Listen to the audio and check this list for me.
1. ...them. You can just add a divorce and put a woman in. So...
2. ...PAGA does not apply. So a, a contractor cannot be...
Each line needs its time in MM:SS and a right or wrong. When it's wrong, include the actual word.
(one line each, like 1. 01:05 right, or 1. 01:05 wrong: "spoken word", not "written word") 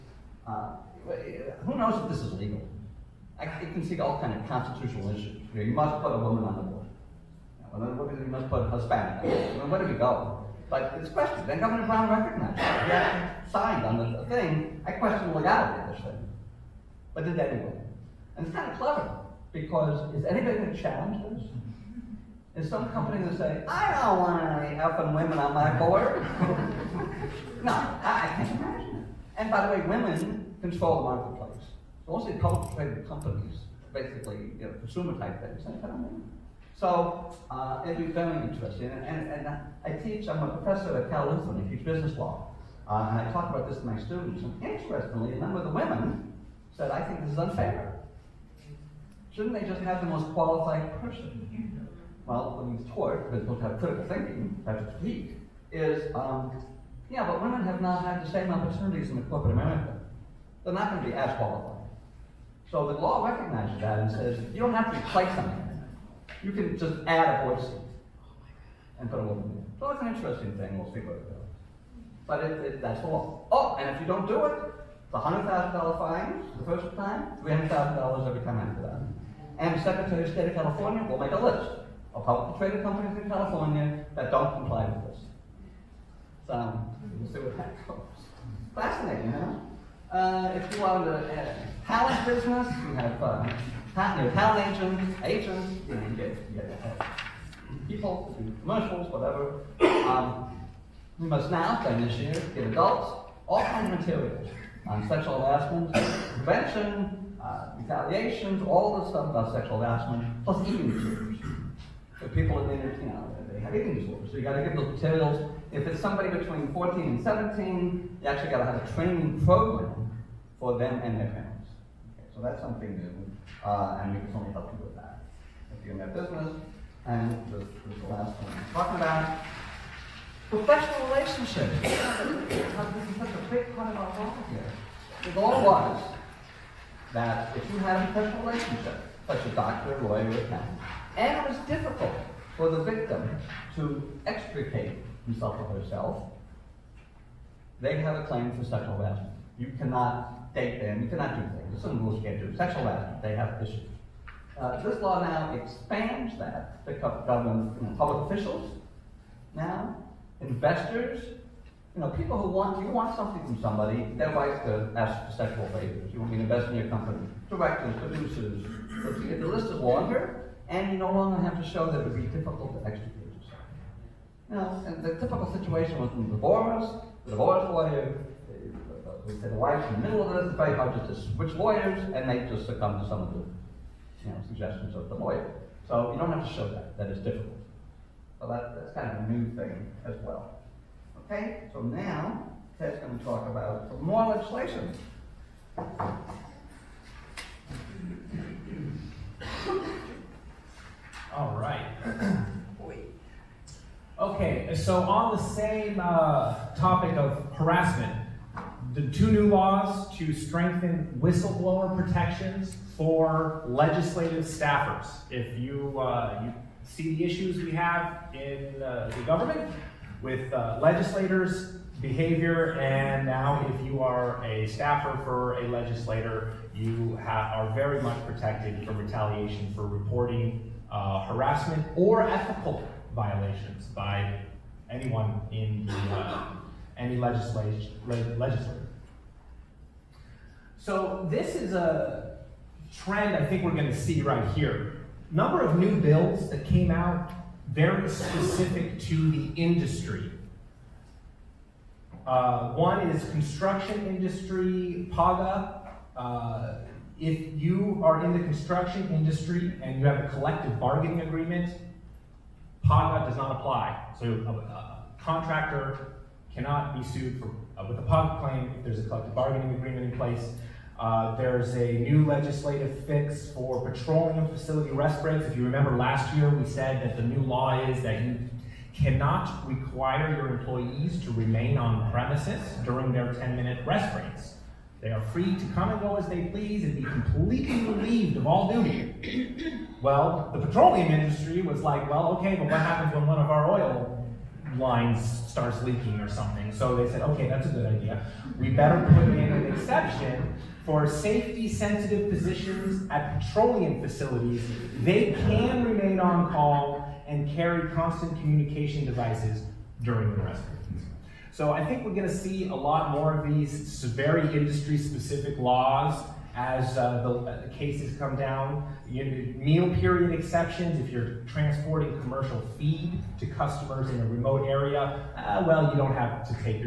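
1. 01:05 wrong: "voice", not "divorce"
2. 04:22 right.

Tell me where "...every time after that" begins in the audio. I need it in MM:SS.
01:18.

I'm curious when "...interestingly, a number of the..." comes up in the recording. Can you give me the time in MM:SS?
00:44.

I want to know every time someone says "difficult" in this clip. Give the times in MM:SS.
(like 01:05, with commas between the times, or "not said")
02:21, 02:52, 03:07.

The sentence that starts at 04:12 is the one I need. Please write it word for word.
Uh, one is construction industry, PAGA.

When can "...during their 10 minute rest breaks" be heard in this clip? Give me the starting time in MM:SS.
04:42.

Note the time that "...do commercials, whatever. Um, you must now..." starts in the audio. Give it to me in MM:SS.
01:38.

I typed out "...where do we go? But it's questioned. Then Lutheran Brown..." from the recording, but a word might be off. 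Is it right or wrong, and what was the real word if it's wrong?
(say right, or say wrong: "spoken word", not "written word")
wrong: "Governor", not "Lutheran".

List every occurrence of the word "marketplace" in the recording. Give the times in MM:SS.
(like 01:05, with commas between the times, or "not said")
00:31.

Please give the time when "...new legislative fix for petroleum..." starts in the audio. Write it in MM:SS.
04:31.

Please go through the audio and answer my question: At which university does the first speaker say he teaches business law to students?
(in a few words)
Cal Lutheran.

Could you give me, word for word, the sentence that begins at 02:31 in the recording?
There's some rules you can't do.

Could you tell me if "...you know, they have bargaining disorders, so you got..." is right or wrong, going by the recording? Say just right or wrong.
wrong.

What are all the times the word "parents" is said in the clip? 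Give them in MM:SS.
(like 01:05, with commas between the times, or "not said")
02:01.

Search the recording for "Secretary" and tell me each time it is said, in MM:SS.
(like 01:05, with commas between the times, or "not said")
01:19.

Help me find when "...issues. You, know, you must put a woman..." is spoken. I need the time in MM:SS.
00:05.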